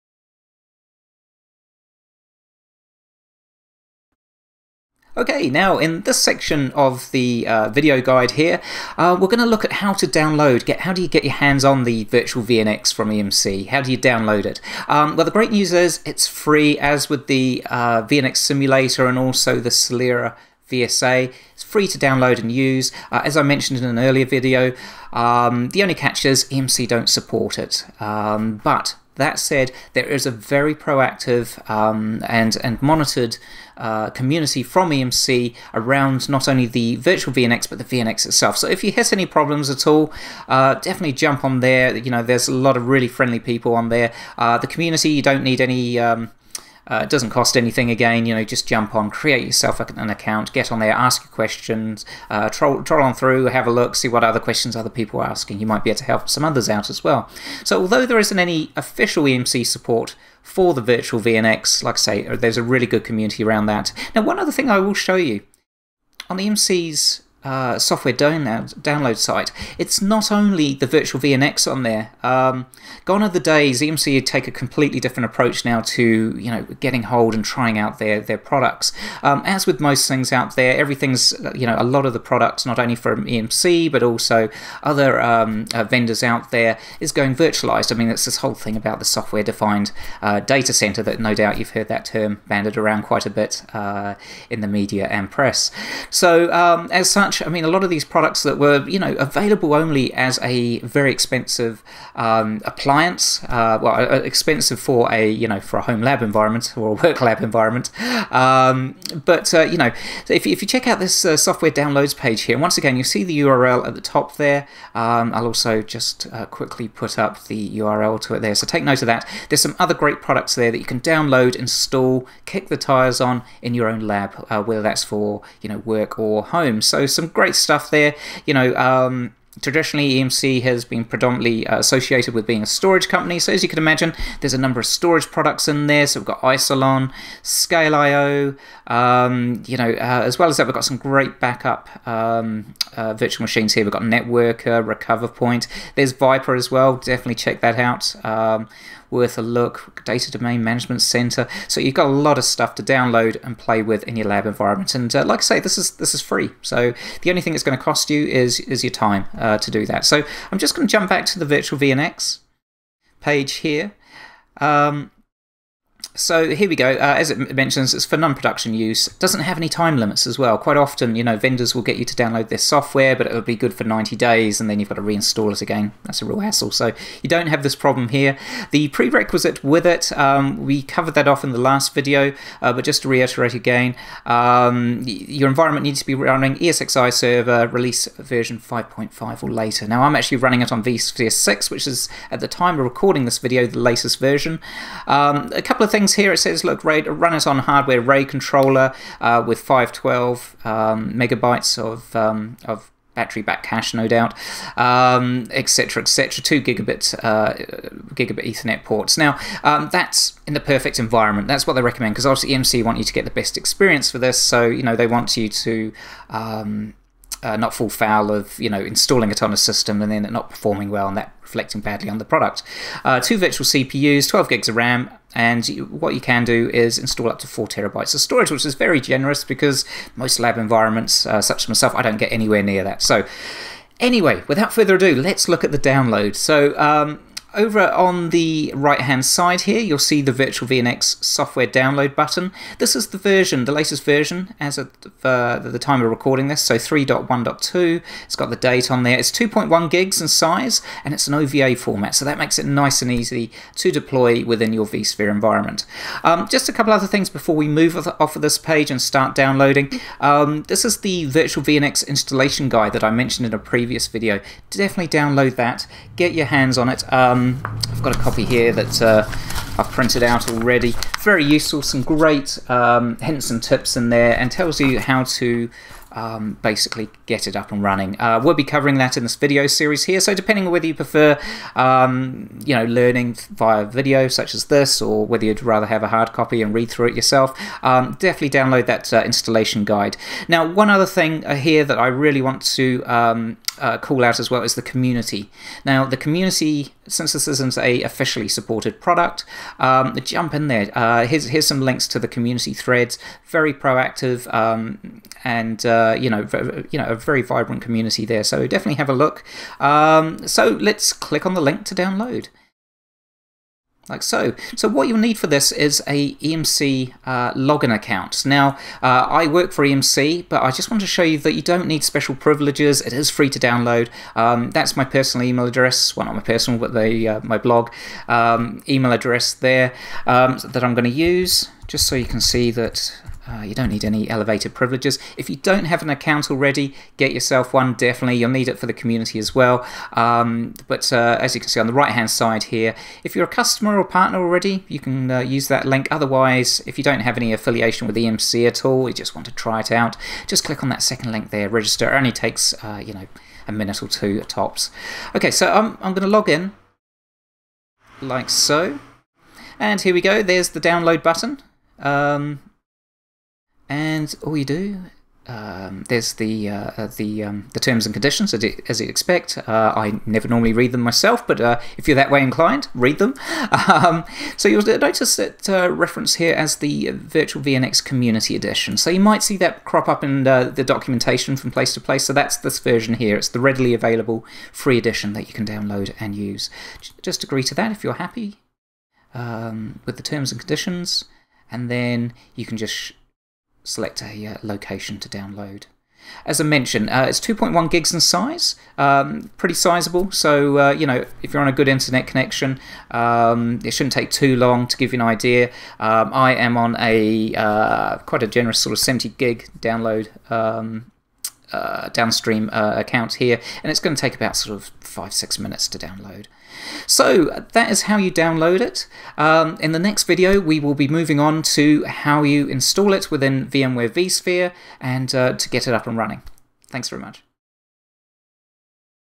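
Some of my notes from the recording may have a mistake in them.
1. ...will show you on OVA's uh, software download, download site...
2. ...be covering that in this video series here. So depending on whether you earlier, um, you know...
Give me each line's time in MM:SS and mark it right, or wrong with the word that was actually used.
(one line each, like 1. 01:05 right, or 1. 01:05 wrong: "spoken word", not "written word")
1. 01:04 wrong: "EMC", not "OVA"
2. 04:38 wrong: "prefer", not "earlier".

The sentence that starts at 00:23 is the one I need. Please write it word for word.
Uh, as I mentioned in an earlier video, um, the only catch is EMC don't support it.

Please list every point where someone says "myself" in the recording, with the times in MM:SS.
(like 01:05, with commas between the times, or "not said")
03:51, 06:11.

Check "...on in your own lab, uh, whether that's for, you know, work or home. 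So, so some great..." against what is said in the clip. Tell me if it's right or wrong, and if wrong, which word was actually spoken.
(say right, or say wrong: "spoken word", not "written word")
right.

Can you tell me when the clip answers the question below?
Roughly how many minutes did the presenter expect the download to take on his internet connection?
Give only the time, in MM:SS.
06:54.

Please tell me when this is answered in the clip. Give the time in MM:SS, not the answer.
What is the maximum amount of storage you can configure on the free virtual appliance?
03:47.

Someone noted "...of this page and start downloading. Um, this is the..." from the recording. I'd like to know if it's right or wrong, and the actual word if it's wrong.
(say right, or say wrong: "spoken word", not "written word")
right.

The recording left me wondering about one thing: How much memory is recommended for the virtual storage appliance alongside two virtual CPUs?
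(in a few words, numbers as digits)
12 GB.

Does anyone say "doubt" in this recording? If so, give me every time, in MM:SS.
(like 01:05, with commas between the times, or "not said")
01:31, 03:24.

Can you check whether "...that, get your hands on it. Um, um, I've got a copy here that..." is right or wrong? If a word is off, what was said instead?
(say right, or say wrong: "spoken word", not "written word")
right.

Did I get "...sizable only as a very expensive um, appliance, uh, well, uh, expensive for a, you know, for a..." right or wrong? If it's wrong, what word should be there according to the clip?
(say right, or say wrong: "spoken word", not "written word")
wrong: "available", not "sizable".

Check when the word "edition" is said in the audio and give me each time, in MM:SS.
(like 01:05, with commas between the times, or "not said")
06:18, 06:24.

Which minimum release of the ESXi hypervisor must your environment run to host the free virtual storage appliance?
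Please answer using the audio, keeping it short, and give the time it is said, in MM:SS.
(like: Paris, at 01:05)
5.5, at 03:08.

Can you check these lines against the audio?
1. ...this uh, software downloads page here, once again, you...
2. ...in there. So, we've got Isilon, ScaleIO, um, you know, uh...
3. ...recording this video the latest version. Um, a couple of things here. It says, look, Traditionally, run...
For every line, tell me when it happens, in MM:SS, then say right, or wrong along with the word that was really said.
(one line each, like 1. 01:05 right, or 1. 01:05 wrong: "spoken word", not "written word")
1. 01:50 right
2. 02:15 right
3. 03:12 wrong: "Ray", not "Traditionally".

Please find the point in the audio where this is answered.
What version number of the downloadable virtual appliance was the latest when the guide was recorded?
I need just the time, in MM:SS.
04:06.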